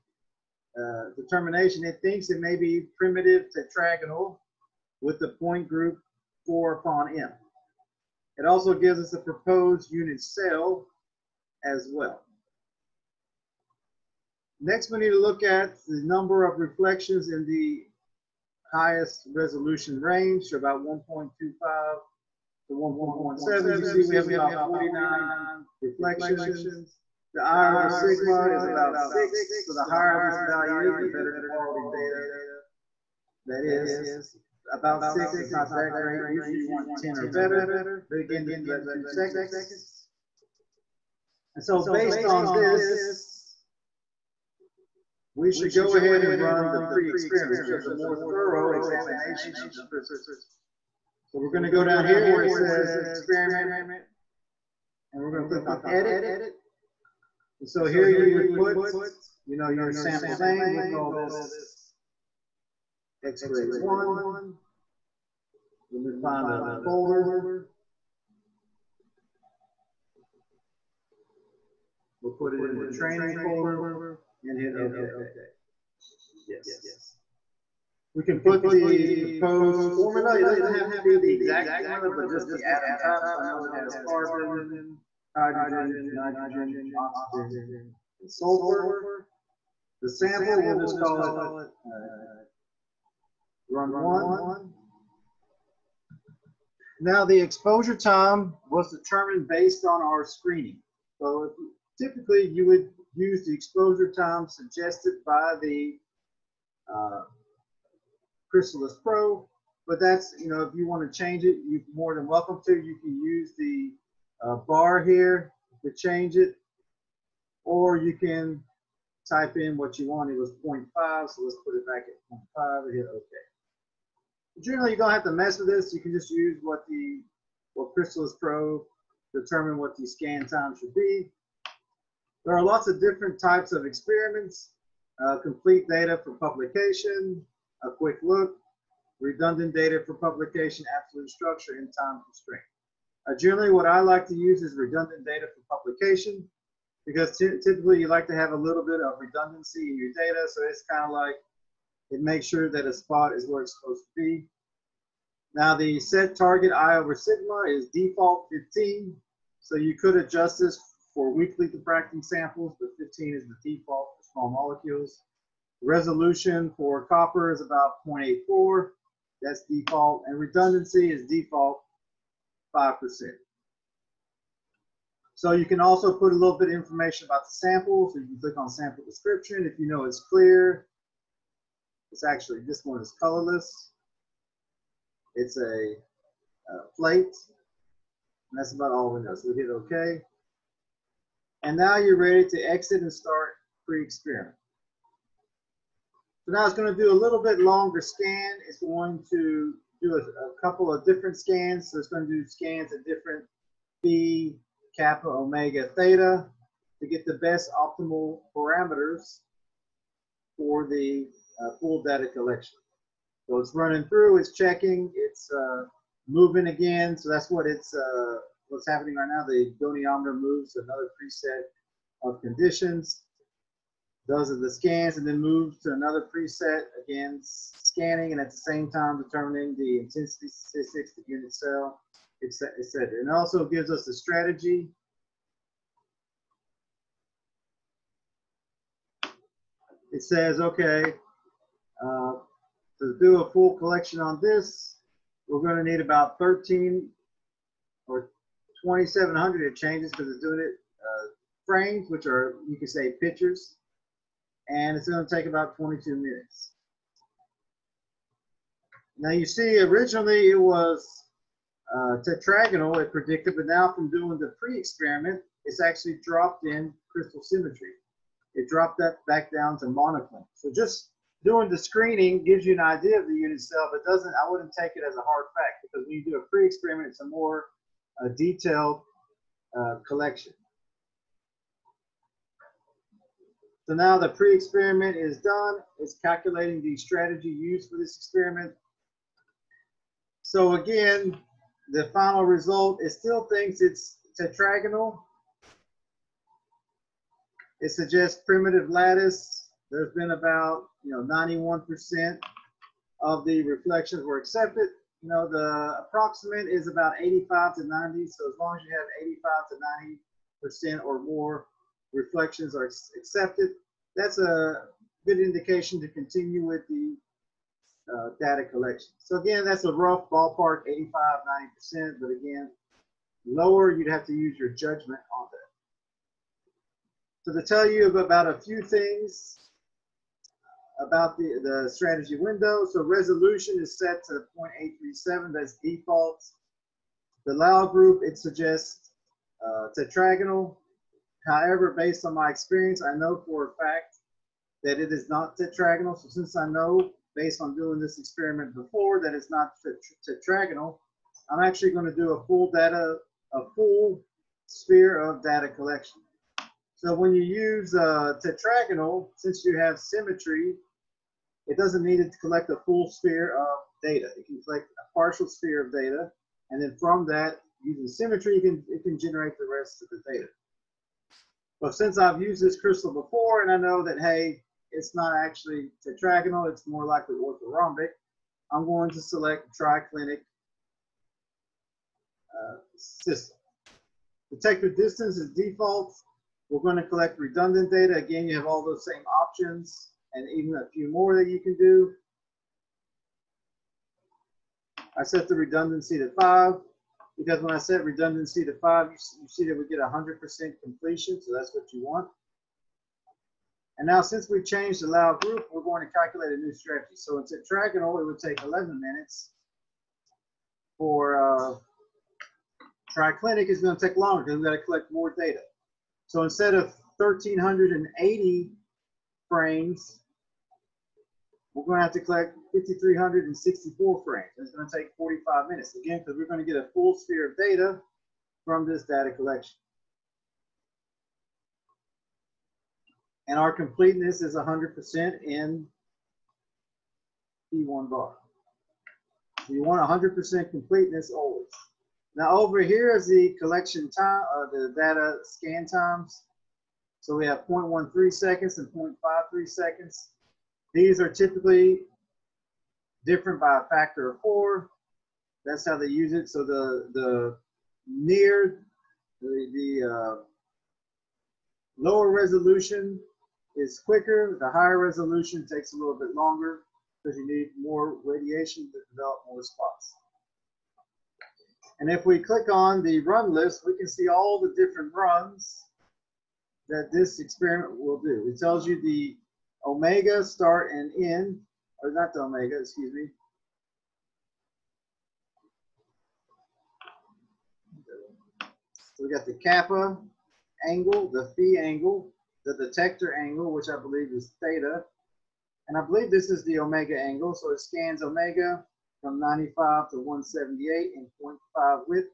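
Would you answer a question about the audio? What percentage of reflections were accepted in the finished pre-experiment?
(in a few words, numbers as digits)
91%.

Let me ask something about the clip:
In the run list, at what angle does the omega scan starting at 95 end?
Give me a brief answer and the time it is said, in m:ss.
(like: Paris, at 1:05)
178, at 8:20.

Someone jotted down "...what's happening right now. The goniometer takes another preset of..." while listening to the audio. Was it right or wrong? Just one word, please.
wrong.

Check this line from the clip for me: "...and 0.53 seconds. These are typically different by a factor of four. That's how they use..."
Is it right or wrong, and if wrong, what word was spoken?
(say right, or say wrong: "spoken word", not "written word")
right.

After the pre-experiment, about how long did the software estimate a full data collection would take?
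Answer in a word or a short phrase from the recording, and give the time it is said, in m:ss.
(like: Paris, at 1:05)
22 minutes, at 4:15.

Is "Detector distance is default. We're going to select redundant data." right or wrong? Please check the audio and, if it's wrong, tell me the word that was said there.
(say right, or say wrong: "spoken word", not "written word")
wrong: "collect", not "select".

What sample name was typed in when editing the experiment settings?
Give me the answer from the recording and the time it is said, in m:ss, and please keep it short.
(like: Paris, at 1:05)
X-ray 1, at 1:03.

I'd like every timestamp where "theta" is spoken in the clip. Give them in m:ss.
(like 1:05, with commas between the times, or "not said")
3:25, 8:14.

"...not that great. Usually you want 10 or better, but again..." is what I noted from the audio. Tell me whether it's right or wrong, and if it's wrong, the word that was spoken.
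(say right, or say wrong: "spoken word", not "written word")
right.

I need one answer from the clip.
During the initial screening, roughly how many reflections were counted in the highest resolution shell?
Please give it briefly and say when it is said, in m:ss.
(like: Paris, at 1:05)
49, at 0:24.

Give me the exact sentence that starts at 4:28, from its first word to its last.
It dropped that back down to monoclinic.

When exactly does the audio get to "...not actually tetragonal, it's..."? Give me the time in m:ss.
6:15.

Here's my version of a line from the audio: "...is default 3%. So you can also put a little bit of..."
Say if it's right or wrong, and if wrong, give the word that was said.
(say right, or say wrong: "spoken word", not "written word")
wrong: "5", not "3".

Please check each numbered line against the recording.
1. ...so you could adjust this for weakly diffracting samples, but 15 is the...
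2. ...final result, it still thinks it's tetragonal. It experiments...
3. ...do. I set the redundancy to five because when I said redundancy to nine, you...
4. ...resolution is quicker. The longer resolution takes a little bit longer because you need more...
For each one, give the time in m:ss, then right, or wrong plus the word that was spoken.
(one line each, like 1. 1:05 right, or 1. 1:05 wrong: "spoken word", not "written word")
1. 2:39 right
2. 4:52 wrong: "suggests", not "experiments"
3. 6:31 wrong: "five", not "nine"
4. 7:42 wrong: "higher", not "longer".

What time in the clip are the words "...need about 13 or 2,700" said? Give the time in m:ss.
4:05.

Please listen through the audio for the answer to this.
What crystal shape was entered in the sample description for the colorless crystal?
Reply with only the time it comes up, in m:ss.
3:06.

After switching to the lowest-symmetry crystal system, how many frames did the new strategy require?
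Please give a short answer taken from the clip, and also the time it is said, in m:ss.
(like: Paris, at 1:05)
5,364, at 7:02.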